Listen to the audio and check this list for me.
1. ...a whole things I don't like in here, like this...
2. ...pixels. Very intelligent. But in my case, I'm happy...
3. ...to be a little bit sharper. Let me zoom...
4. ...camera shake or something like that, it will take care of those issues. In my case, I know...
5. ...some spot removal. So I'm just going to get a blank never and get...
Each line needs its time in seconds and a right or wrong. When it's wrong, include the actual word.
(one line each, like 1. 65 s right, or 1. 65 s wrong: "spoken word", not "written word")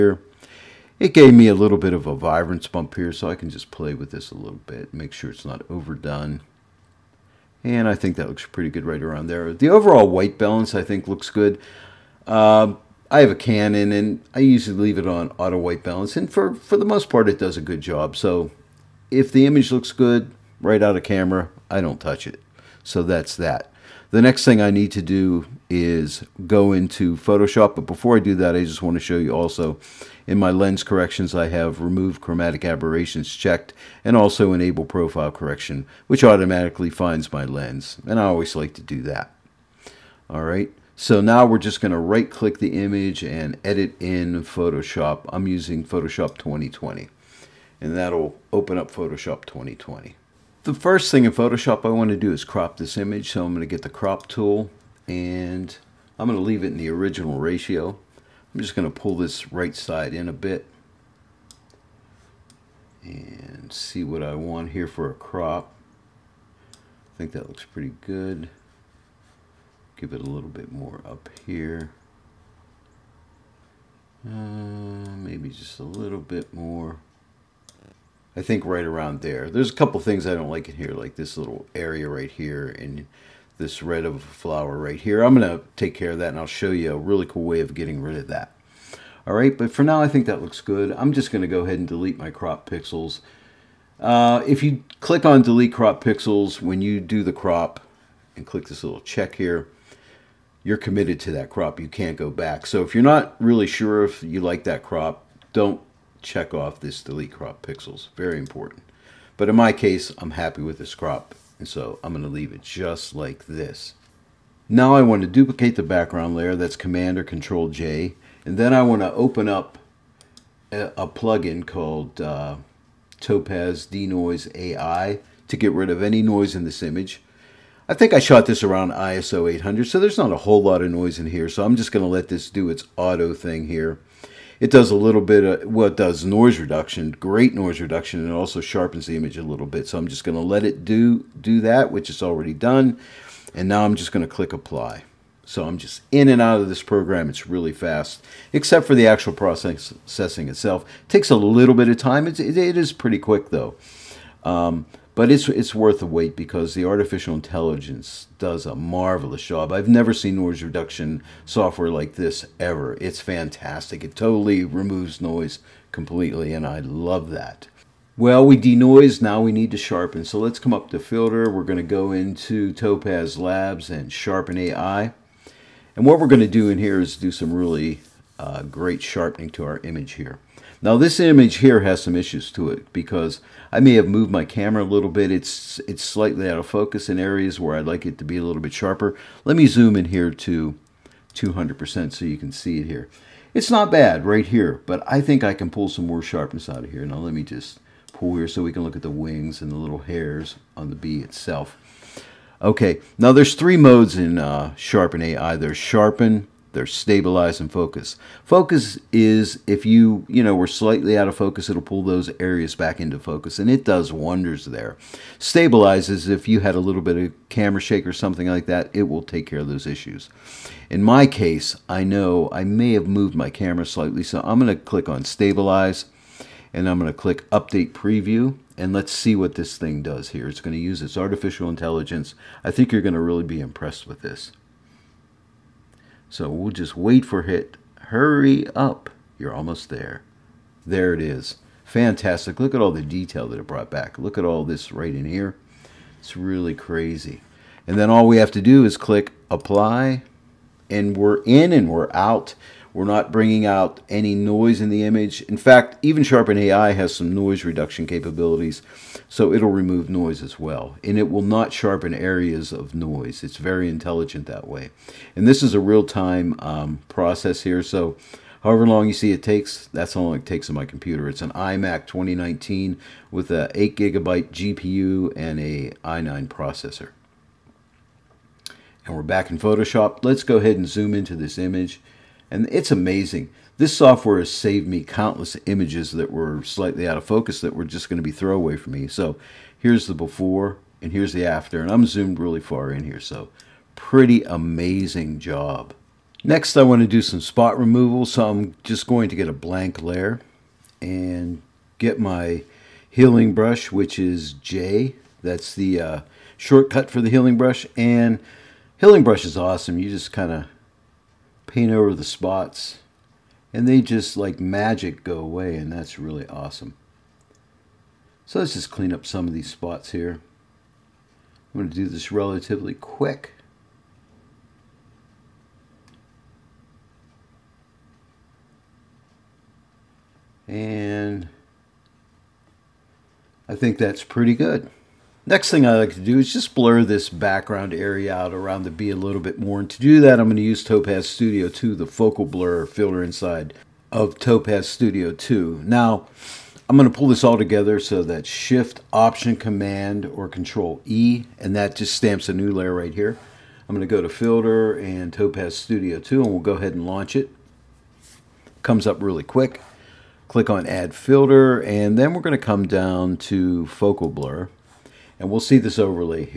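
1. 79 s wrong: "couple", not "whole"
2. 107 s wrong: "important", not "intelligent"
3. 188 s right
4. 217 s right
5. 297 s wrong: "layer", not "never".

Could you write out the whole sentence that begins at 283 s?
This software has saved me countless images that were slightly out of focus that were just going to be throwaway for me.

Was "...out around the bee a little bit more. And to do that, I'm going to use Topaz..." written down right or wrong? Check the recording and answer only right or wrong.
right.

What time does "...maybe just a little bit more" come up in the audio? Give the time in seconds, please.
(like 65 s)
74 s.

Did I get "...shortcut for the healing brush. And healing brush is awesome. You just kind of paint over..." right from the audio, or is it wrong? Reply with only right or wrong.
right.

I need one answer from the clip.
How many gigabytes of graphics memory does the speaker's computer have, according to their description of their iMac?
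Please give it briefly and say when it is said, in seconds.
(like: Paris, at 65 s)
8, at 273 s.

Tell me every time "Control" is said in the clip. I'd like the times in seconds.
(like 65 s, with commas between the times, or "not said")
117 s, 350 s.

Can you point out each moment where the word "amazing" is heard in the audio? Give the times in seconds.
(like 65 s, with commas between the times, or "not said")
282 s, 294 s.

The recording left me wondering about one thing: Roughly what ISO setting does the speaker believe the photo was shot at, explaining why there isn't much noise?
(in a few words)
800.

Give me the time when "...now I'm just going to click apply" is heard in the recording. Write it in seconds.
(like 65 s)
143 s.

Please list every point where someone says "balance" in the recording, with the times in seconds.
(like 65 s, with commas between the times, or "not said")
10 s, 15 s.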